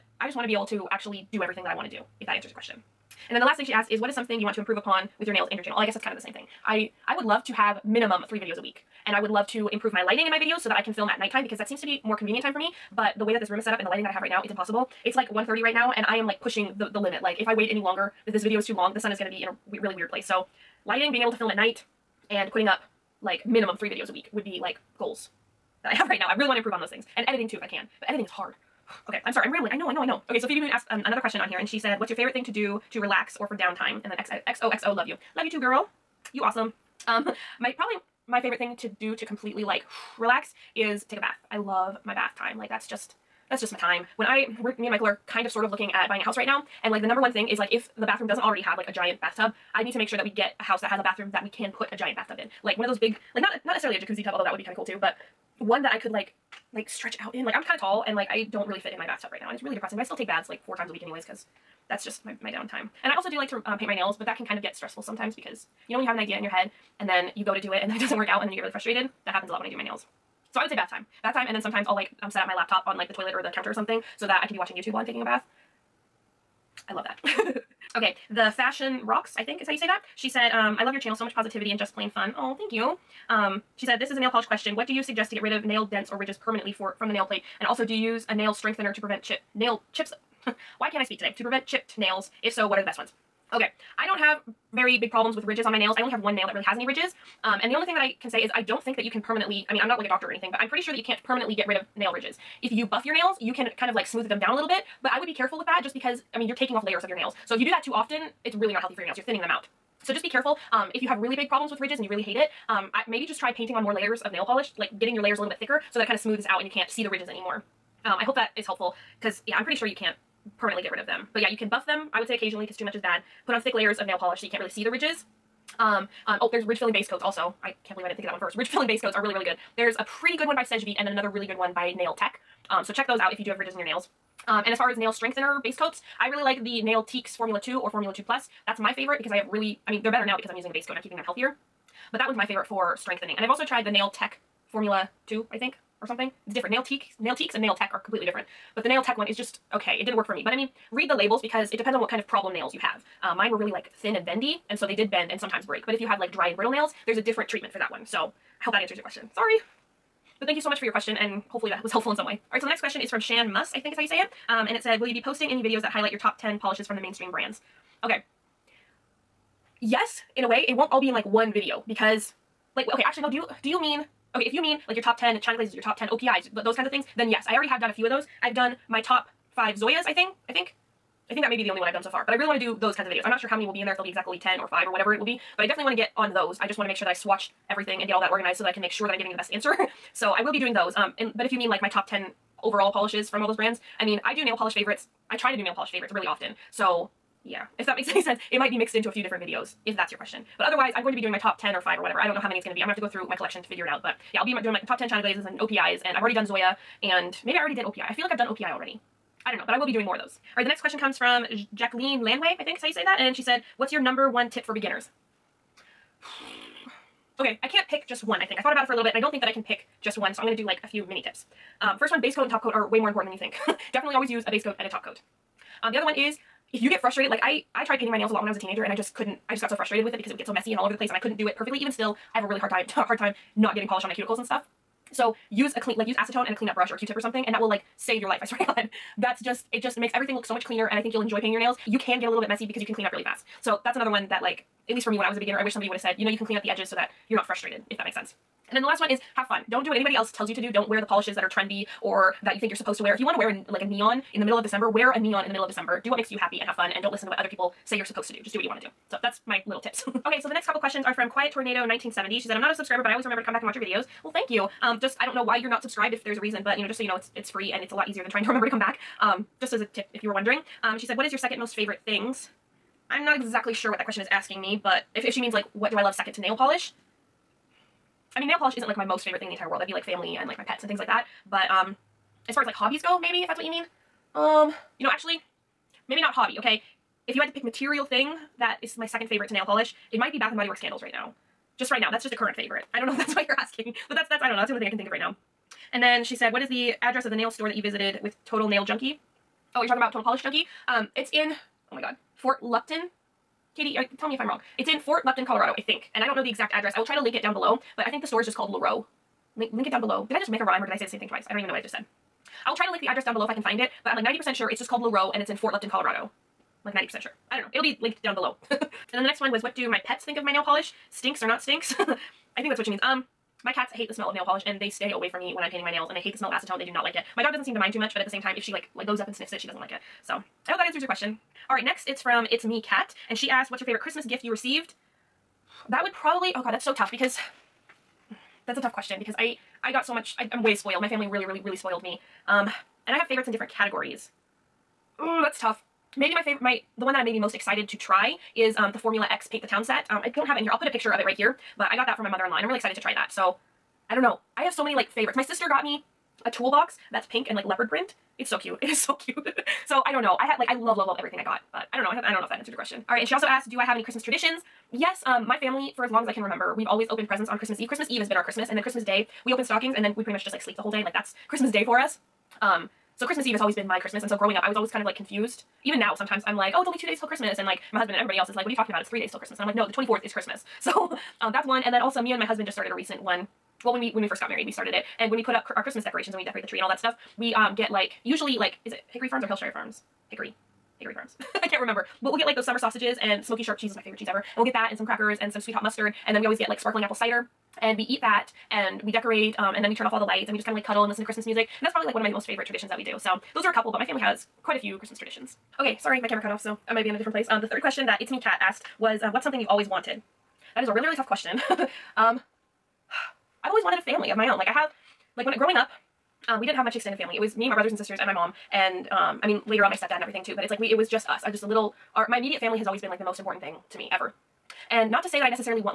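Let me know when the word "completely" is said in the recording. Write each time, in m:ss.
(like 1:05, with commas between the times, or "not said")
0:39, 2:28.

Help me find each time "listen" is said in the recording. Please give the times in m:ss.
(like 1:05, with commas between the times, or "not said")
4:17, 6:41.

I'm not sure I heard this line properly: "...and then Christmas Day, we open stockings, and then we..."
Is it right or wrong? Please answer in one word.
right.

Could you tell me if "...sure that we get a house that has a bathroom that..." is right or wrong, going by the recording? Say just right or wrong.
right.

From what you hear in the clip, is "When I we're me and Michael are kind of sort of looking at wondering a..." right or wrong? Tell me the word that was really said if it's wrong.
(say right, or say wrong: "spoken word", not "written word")
wrong: "buying", not "wondering".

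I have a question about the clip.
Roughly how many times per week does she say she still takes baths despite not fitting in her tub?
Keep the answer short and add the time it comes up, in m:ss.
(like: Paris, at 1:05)
4, at 1:00.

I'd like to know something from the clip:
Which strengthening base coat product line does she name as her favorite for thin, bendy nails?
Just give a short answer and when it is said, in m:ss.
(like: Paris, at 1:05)
Nailtiques Formula 2, at 2:16.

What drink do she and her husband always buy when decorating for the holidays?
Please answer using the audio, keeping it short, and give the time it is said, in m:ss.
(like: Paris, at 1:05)
sparkling apple cider, at 6:36.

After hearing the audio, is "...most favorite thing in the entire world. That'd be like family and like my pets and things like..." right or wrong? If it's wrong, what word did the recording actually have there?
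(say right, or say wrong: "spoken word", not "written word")
right.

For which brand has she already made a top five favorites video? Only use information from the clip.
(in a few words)
Zoya.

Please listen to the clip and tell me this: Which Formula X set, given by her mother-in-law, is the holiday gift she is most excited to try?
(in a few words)
Paint the Town.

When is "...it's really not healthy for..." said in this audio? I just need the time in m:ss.
1:48.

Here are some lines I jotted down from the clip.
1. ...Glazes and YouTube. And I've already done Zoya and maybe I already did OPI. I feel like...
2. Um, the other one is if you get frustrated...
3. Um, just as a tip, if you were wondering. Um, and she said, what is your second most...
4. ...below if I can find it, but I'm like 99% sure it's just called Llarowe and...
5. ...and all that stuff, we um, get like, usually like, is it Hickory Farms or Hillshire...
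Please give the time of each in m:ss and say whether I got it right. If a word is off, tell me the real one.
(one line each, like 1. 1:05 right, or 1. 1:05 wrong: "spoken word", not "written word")
1. 3:25 wrong: "OPIs", not "YouTube"
2. 3:45 right
3. 4:29 right
4. 5:13 wrong: "90", not "99"
5. 6:26 right.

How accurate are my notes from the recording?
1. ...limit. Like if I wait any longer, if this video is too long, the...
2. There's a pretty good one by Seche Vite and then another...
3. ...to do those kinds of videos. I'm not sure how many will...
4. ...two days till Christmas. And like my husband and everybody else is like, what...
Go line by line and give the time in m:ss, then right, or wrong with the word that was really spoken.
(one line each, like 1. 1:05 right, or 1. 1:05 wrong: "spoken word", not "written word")
1. 0:16 right
2. 2:09 right
3. 3:02 right
4. 6:16 right.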